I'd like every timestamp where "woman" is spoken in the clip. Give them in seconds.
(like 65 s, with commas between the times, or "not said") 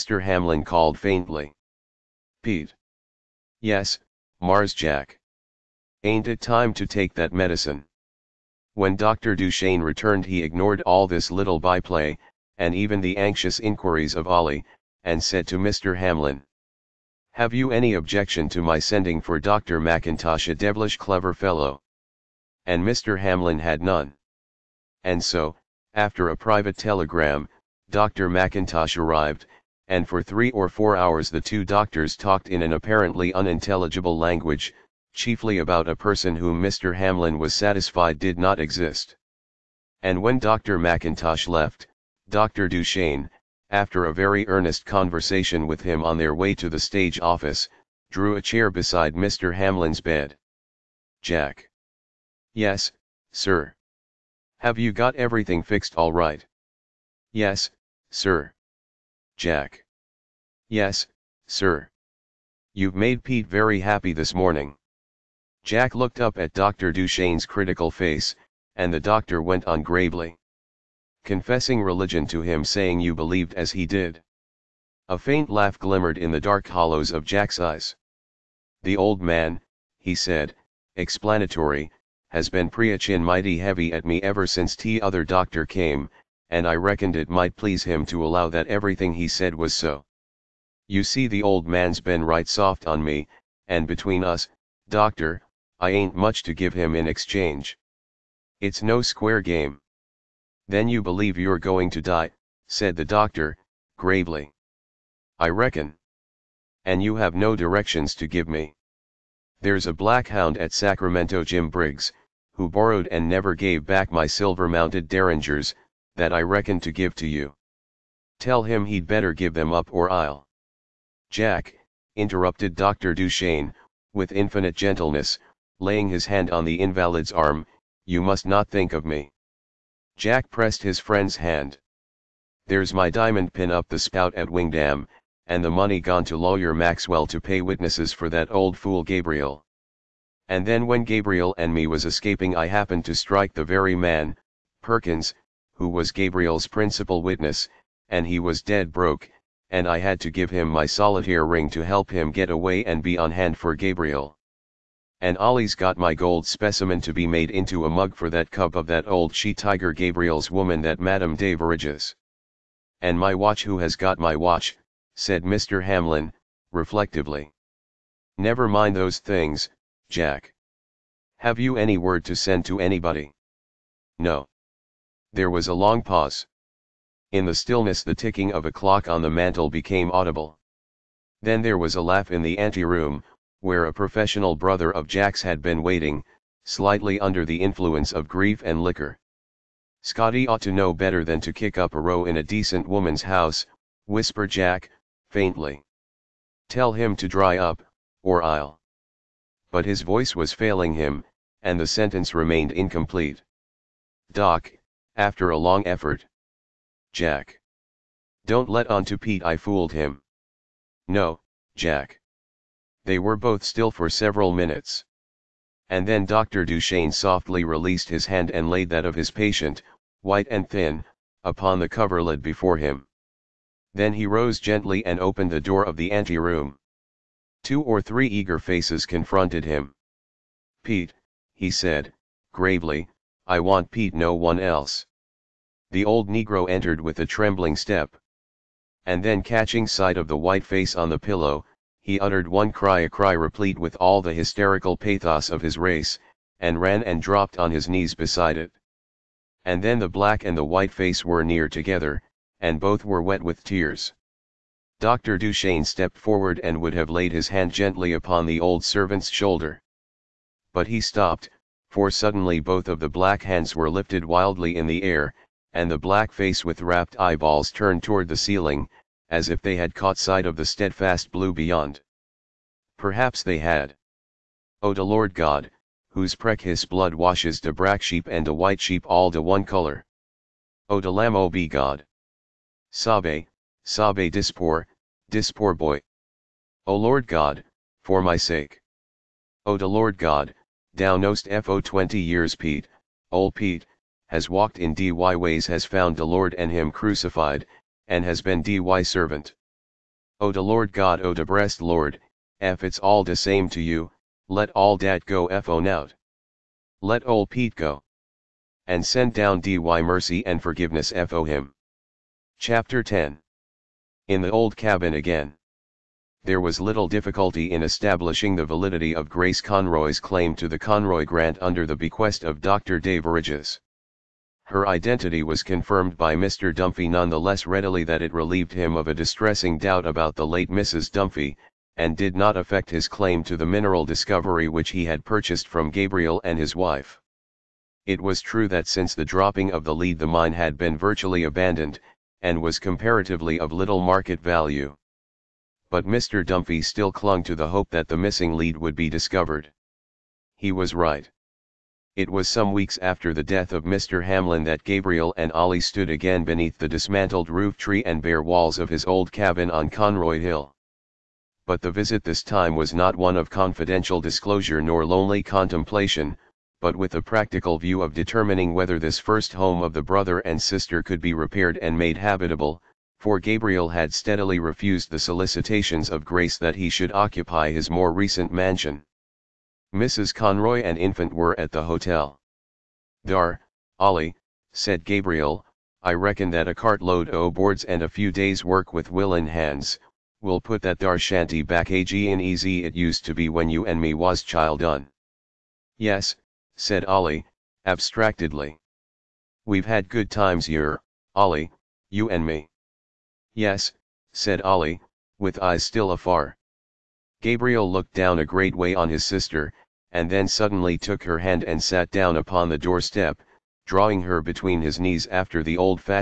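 160 s, 192 s.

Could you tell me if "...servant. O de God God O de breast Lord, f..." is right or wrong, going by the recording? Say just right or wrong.
wrong.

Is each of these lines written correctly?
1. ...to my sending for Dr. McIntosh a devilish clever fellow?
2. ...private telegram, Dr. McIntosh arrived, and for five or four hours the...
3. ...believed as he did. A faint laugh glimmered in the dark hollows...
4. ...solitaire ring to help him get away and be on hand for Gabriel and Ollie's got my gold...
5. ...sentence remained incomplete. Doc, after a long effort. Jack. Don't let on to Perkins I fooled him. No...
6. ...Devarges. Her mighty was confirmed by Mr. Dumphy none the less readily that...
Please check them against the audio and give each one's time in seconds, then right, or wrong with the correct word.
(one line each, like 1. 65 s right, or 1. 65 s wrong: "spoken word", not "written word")
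1. 18 s right
2. 26 s wrong: "three", not "five"
3. 73 s right
4. 150 s right
5. 201 s wrong: "Pete", not "Perkins"
6. 322 s wrong: "identity", not "mighty".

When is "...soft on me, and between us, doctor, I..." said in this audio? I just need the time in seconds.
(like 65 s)
92 s.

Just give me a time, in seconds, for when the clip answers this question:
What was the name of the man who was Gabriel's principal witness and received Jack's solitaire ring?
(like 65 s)
144 s.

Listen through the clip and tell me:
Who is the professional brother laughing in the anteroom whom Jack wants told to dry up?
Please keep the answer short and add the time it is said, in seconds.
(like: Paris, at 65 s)
Scotty, at 190 s.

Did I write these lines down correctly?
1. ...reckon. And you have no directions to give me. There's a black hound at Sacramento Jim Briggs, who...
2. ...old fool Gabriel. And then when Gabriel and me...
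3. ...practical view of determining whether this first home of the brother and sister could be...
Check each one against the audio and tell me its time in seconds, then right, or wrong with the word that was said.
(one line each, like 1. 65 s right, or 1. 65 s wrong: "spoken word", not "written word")
1. 105 s right
2. 138 s right
3. 367 s right.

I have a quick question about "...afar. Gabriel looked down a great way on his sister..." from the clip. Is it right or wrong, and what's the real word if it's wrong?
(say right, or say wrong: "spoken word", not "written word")
right.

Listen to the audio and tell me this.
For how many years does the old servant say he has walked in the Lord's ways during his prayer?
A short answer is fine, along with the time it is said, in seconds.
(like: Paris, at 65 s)
20, at 291 s.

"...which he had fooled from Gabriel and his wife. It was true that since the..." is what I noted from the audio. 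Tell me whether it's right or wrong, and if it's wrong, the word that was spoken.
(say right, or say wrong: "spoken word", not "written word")
wrong: "purchased", not "fooled".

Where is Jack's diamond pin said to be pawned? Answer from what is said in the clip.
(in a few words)
Wingdam.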